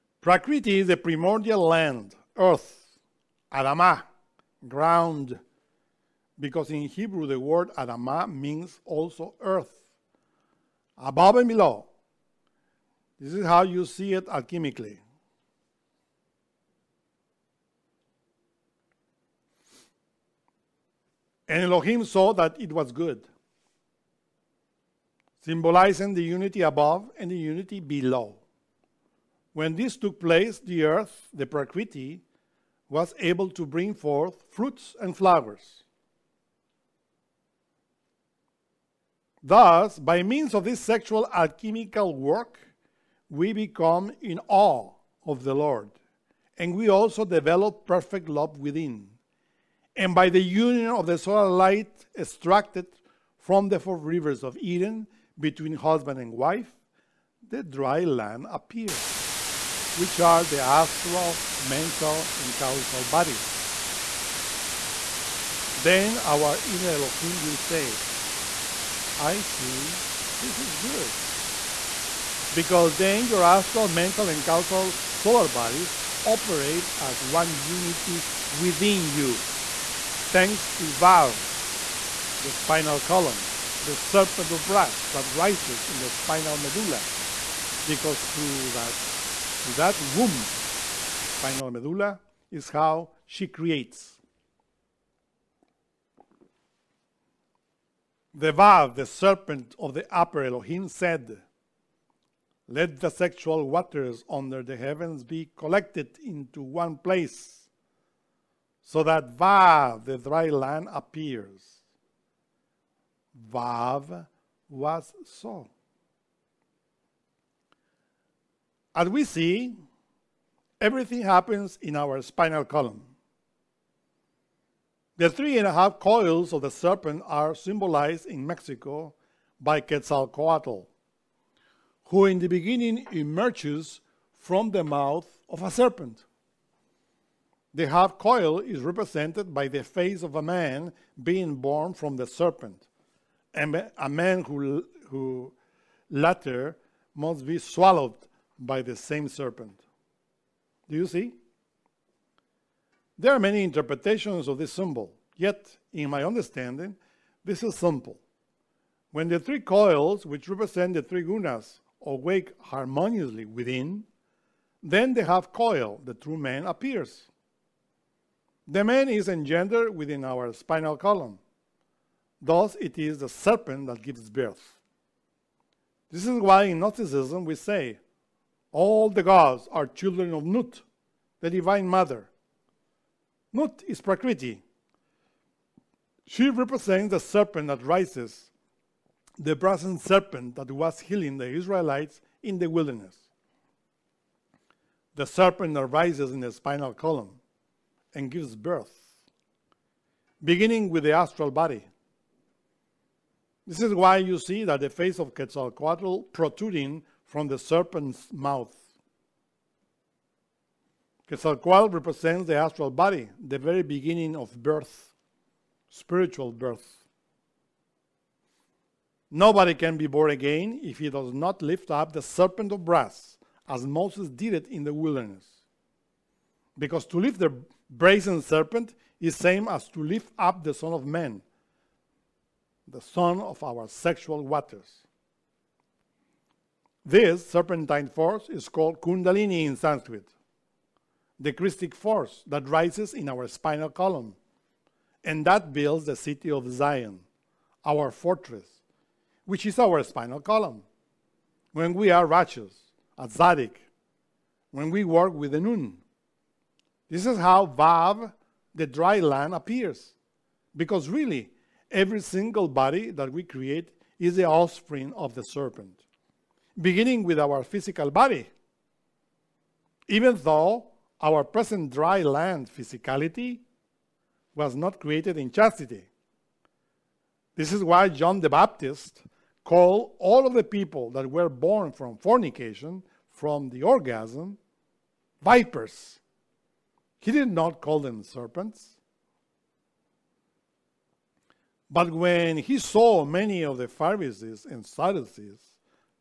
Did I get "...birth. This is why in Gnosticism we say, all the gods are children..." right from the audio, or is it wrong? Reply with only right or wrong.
right.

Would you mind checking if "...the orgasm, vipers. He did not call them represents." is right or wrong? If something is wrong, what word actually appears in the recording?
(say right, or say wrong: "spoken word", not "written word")
wrong: "serpents", not "represents".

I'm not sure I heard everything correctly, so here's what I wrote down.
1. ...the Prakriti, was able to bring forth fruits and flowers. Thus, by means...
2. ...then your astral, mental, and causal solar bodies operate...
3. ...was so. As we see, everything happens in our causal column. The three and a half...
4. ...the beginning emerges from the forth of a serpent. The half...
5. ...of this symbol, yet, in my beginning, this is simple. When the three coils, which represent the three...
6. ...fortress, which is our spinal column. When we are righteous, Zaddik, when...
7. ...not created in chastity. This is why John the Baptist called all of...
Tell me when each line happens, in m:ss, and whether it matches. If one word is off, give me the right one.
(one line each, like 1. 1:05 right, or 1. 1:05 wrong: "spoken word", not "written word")
1. 0:31 right
2. 1:12 right
3. 1:54 wrong: "spinal", not "causal"
4. 2:12 wrong: "mouth", not "forth"
5. 2:34 wrong: "understanding", not "beginning"
6. 4:08 right
7. 4:34 right.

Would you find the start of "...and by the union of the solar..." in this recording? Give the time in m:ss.
0:50.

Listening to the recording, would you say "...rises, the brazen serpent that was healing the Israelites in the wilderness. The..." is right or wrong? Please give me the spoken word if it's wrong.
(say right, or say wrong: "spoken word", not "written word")
right.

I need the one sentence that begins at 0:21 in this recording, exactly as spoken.
And Elohim saw that it was good, symbolizing the unity above and the unity below.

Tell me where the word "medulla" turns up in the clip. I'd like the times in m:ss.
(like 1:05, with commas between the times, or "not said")
1:26, 1:31.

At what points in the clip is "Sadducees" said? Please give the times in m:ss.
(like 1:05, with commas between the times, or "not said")
4:54.